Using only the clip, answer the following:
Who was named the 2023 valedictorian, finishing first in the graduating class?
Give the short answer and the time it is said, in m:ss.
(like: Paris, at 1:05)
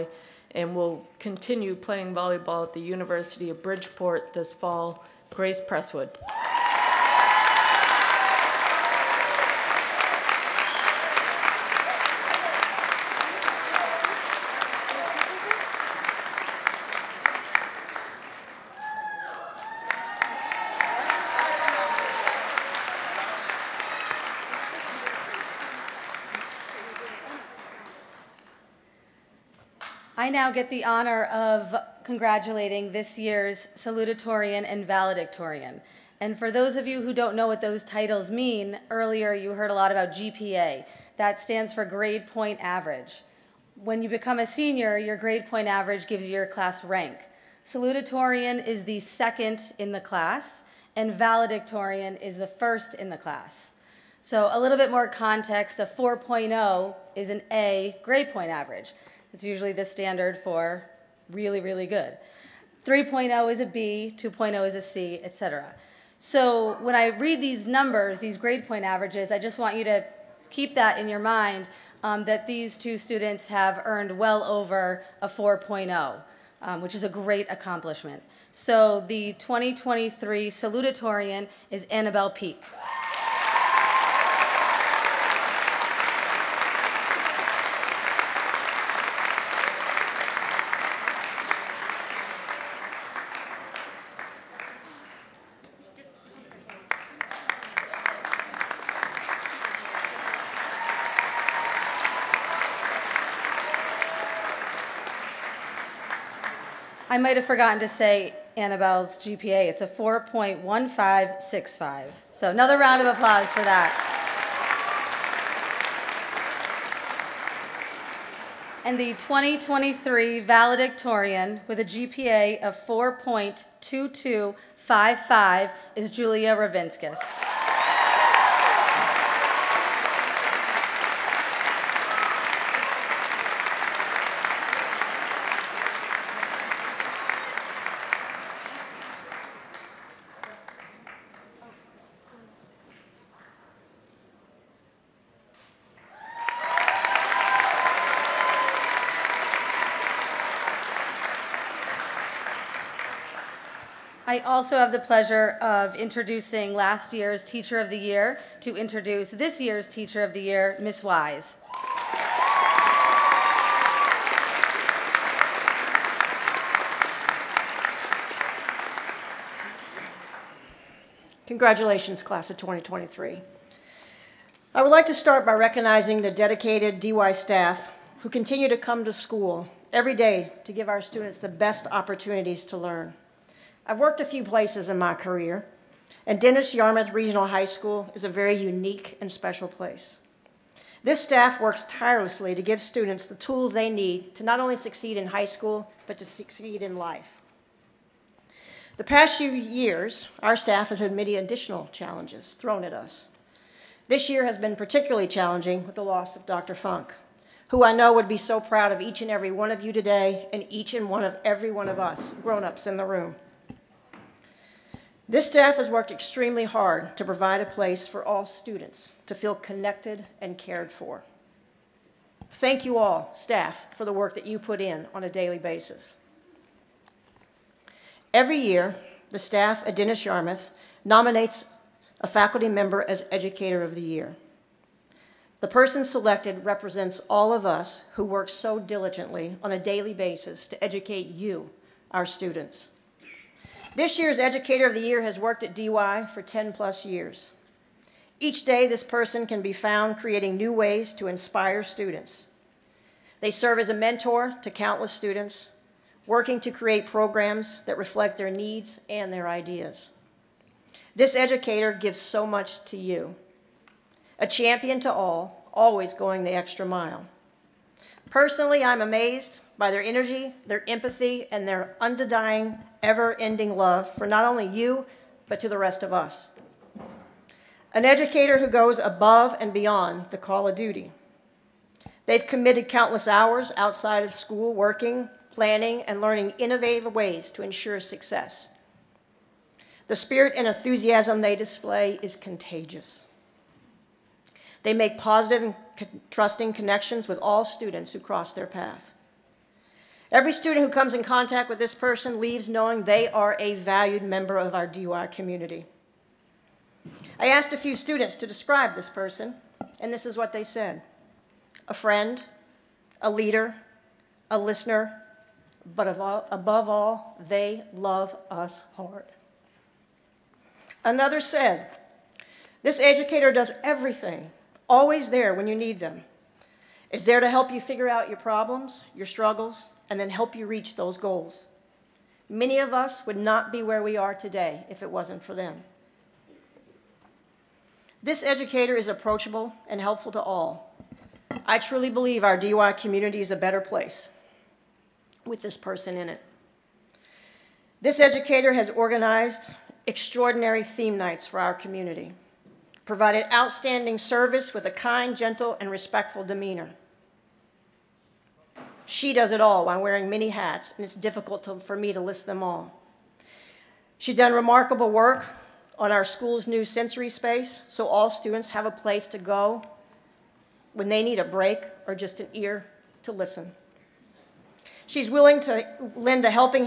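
Julia Ravinskis, at 2:06.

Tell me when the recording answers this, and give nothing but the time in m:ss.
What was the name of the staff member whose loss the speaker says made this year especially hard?
3:26.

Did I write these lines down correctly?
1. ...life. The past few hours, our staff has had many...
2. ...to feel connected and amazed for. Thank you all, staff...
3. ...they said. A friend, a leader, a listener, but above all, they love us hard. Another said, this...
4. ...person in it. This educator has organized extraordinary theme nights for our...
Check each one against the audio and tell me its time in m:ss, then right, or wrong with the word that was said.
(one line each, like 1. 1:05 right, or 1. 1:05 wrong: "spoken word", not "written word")
1. 3:16 wrong: "years", not "hours"
2. 3:39 wrong: "cared", not "amazed"
3. 5:10 right
4. 5:45 right.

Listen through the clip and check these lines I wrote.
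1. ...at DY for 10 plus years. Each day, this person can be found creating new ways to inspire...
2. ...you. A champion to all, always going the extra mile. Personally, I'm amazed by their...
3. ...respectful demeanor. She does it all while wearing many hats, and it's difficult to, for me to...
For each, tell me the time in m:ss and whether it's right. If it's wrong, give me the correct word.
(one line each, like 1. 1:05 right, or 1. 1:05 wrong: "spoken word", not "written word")
1. 4:05 right
2. 4:22 right
3. 5:55 right.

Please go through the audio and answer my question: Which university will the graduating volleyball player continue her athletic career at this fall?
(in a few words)
University of Bridgeport.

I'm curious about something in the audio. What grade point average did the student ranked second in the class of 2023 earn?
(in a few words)
4.1565.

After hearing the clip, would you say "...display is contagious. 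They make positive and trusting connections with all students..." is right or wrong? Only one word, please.
right.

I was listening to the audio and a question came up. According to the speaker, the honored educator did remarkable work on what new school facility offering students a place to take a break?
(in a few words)
sensory space.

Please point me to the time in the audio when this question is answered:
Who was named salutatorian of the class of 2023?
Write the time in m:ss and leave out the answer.
1:21.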